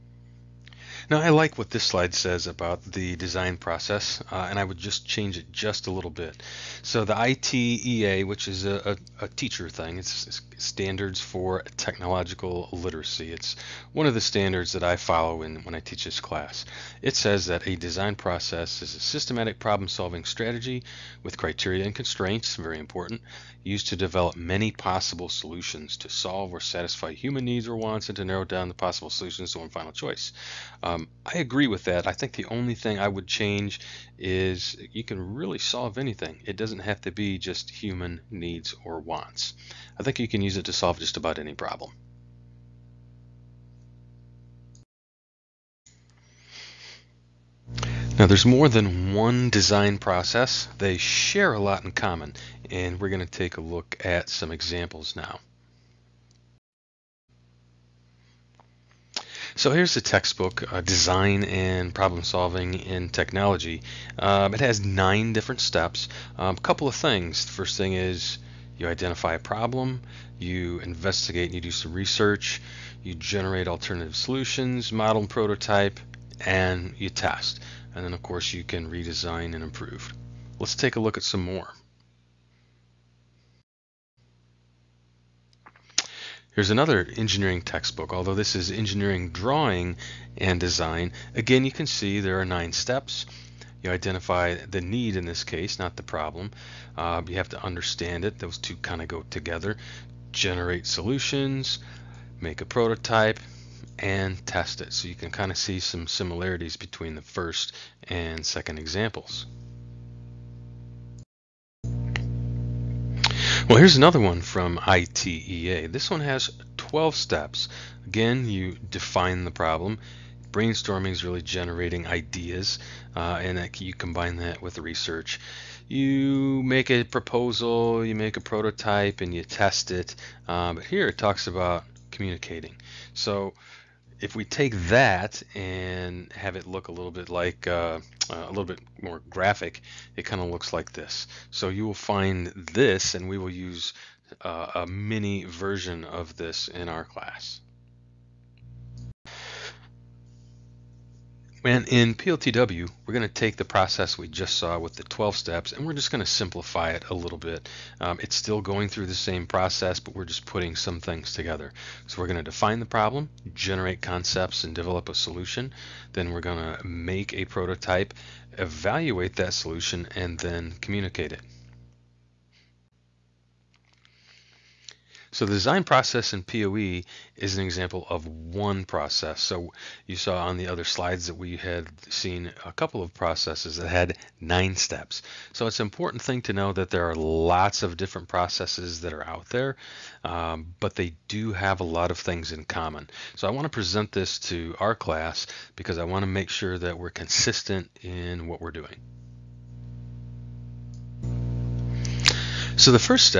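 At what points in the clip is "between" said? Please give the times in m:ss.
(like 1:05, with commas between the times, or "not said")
1:46.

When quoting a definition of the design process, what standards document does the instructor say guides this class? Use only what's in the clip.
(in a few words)
Standards for Technological Literacy.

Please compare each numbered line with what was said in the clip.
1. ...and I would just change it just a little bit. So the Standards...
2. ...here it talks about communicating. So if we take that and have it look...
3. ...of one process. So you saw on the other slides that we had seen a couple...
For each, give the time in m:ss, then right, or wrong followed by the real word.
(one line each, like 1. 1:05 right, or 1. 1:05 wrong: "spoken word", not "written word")
1. 0:04 wrong: "ITEA", not "Standards"
2. 2:10 right
3. 2:58 right.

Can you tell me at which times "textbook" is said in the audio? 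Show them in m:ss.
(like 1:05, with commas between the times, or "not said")
1:00, 1:27.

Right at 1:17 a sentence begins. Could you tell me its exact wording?
And then of course you can redesign and improve.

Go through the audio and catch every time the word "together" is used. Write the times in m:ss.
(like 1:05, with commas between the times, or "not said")
1:39, 2:41.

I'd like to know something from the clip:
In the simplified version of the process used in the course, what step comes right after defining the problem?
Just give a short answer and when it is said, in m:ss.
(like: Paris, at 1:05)
generate concepts, at 2:43.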